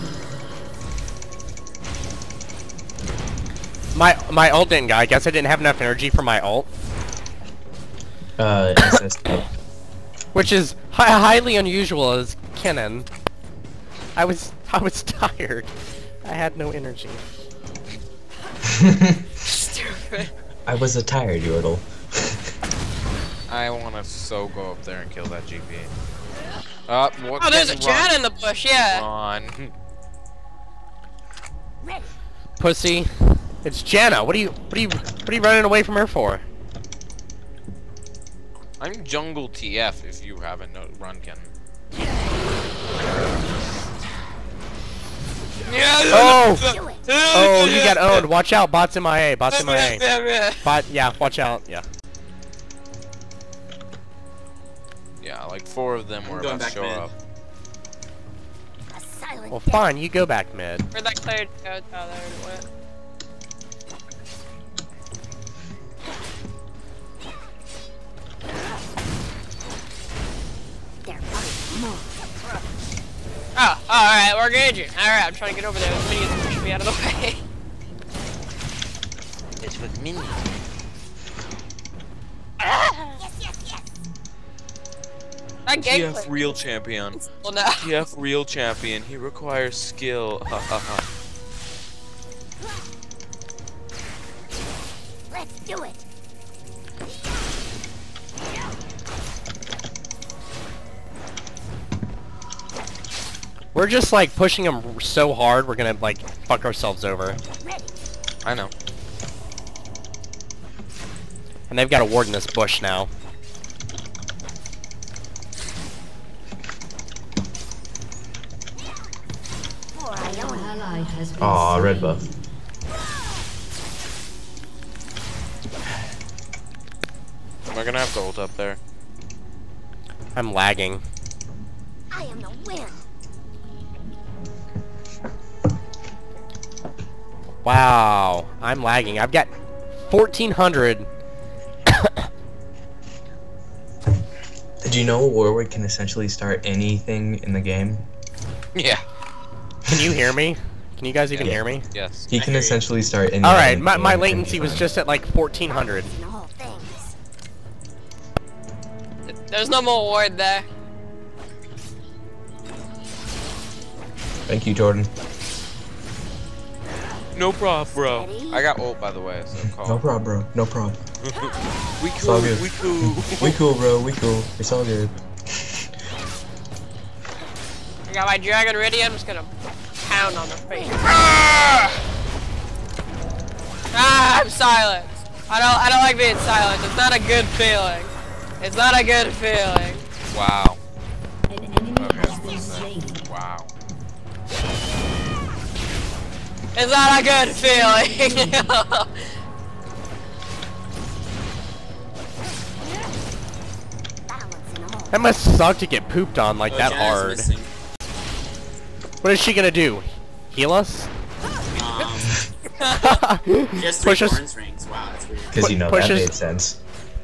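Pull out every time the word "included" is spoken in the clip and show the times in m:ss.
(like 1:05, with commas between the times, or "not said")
not said.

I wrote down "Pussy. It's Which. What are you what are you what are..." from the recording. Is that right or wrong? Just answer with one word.
wrong.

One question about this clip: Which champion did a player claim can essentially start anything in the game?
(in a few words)
Warwick.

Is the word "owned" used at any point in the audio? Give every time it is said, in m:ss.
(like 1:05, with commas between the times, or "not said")
0:47.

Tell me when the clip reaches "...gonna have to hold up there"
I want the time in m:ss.
2:07.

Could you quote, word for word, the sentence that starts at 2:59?
I'm just gonna pound on the face.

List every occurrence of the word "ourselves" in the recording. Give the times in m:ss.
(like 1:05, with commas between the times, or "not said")
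1:46.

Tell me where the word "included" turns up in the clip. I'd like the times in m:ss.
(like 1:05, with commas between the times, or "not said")
not said.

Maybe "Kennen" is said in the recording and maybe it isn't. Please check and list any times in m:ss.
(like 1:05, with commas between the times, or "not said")
0:12.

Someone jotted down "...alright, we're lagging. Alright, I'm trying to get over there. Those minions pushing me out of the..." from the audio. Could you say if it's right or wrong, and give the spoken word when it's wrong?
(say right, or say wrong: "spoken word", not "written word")
wrong: "engaging", not "lagging".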